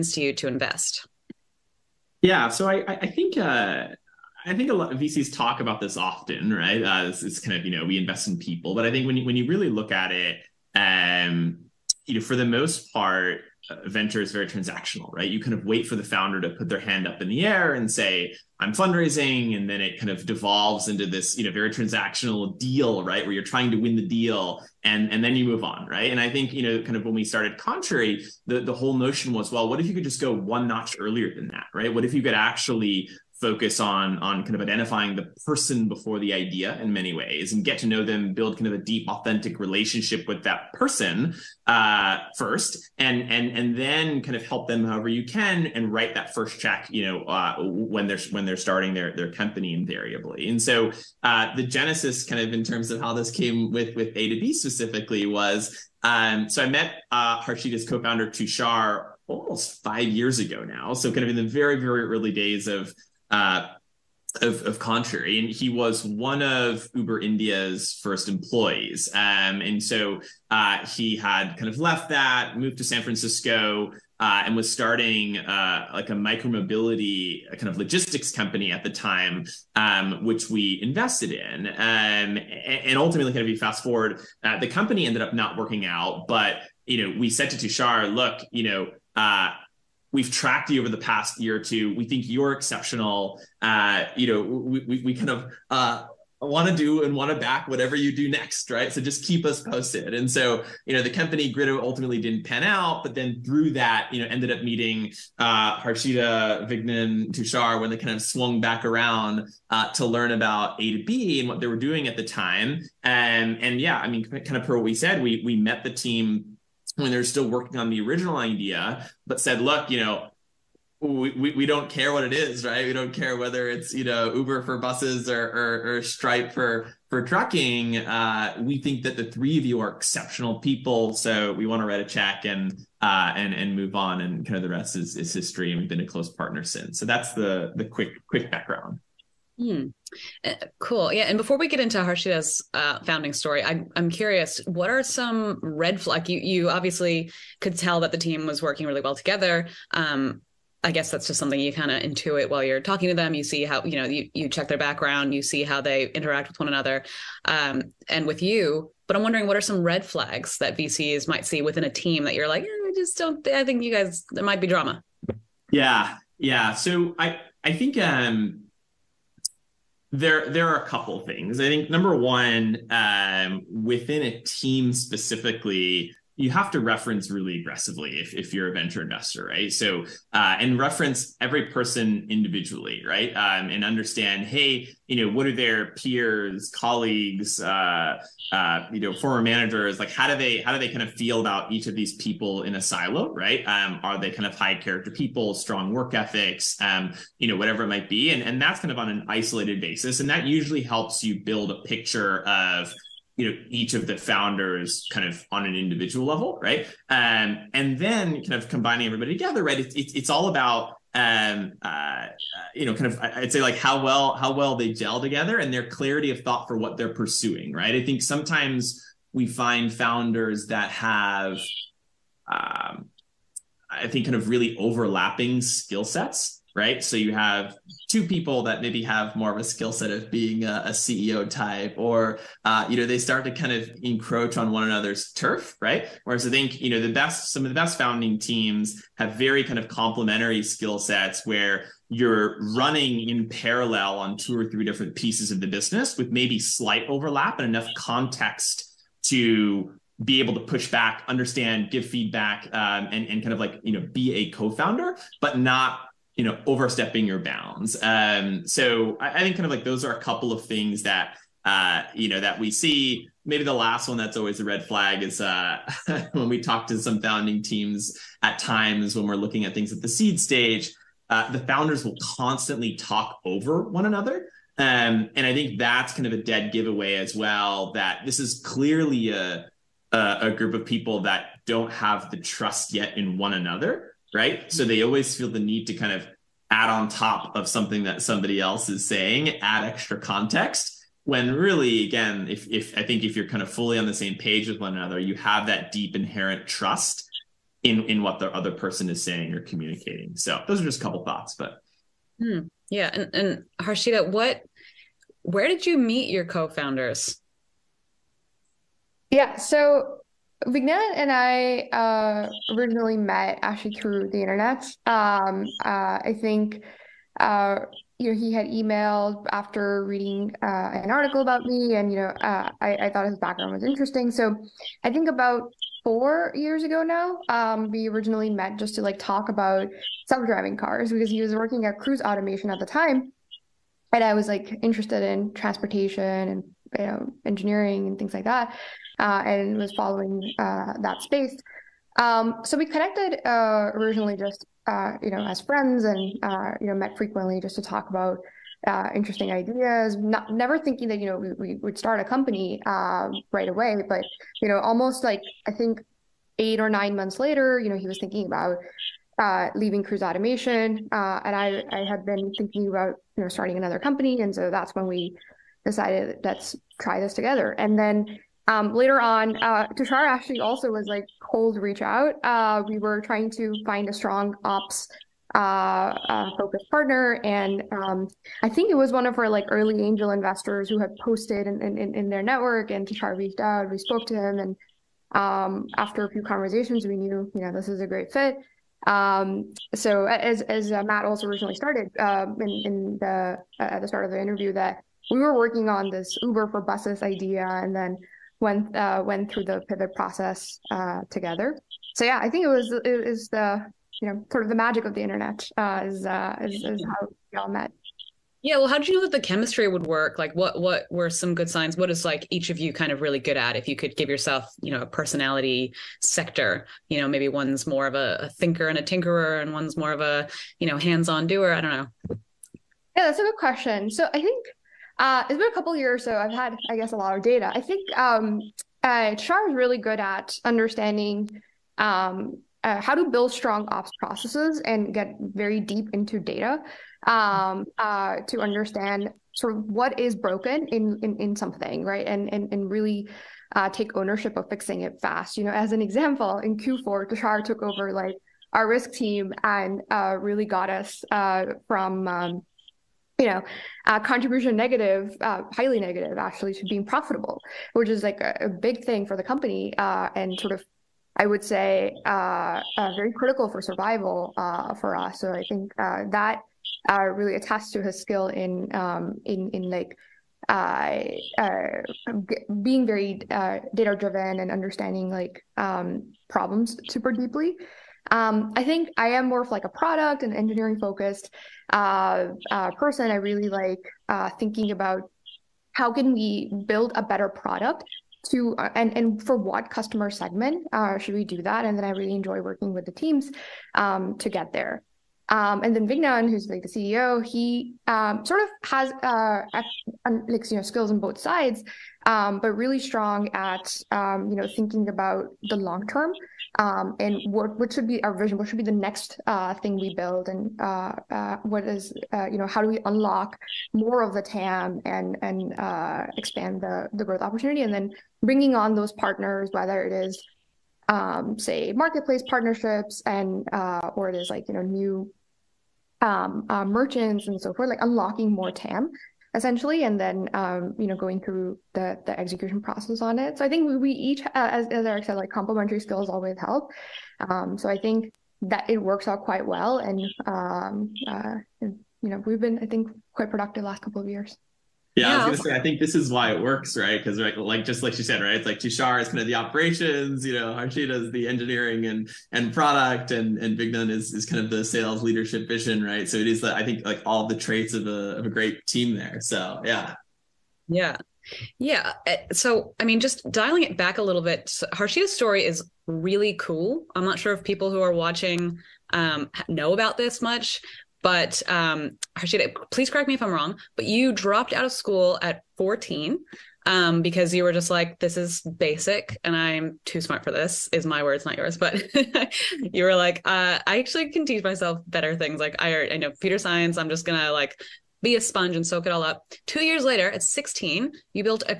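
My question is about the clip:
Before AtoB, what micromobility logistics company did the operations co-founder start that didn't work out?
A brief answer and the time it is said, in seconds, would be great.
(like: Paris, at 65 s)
Grido, at 101 s.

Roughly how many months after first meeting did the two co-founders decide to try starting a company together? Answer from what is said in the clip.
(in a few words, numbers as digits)
8 or 9.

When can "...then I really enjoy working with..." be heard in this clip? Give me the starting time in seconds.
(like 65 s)
491 s.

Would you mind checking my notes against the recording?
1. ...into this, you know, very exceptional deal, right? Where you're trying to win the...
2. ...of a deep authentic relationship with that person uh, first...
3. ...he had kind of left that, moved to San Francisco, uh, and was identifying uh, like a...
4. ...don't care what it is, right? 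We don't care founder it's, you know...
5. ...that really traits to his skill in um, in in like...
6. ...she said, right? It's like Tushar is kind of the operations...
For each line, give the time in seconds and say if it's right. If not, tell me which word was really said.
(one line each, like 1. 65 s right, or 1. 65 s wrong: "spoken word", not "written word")
1. 20 s wrong: "transactional", not "exceptional"
2. 38 s right
3. 70 s wrong: "starting", not "identifying"
4. 121 s wrong: "whether", not "founder"
5. 465 s wrong: "attests", not "traits"
6. 548 s right.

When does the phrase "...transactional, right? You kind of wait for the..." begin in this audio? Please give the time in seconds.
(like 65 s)
14 s.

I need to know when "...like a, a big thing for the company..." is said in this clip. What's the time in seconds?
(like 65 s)
458 s.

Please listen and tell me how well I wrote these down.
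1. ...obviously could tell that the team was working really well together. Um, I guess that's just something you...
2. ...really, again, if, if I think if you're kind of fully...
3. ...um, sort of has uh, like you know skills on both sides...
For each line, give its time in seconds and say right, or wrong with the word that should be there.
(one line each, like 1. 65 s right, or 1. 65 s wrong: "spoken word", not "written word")
1. 146 s right
2. 291 s right
3. 498 s right.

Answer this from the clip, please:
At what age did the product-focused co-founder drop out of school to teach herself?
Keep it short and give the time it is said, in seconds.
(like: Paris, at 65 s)
14, at 575 s.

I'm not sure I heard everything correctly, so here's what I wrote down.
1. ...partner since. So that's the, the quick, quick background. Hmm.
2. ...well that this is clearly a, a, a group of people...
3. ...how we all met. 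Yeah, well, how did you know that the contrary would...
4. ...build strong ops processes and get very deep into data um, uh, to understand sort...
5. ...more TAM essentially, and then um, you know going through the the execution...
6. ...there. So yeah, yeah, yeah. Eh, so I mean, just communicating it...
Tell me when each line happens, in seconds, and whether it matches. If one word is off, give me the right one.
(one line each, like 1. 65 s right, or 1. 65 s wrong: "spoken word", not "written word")
1. 136 s right
2. 277 s right
3. 407 s wrong: "chemistry", not "contrary"
4. 433 s right
5. 528 s right
6. 559 s wrong: "dialing", not "communicating".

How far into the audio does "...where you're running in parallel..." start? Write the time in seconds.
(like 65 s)
241 s.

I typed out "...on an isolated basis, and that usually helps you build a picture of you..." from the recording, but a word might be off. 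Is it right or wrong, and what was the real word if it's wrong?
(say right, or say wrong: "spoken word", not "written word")
right.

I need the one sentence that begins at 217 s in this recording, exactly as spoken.
I think sometimes we find founders that have, um, I think, kind of really overlapping skill sets, right?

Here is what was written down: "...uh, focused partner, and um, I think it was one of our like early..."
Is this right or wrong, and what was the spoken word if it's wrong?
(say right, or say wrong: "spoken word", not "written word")
right.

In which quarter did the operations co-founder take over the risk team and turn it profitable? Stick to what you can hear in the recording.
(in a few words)
Q4.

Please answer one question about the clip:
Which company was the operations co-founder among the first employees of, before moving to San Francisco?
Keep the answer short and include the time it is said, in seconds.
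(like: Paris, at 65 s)
Uber India, at 66 s.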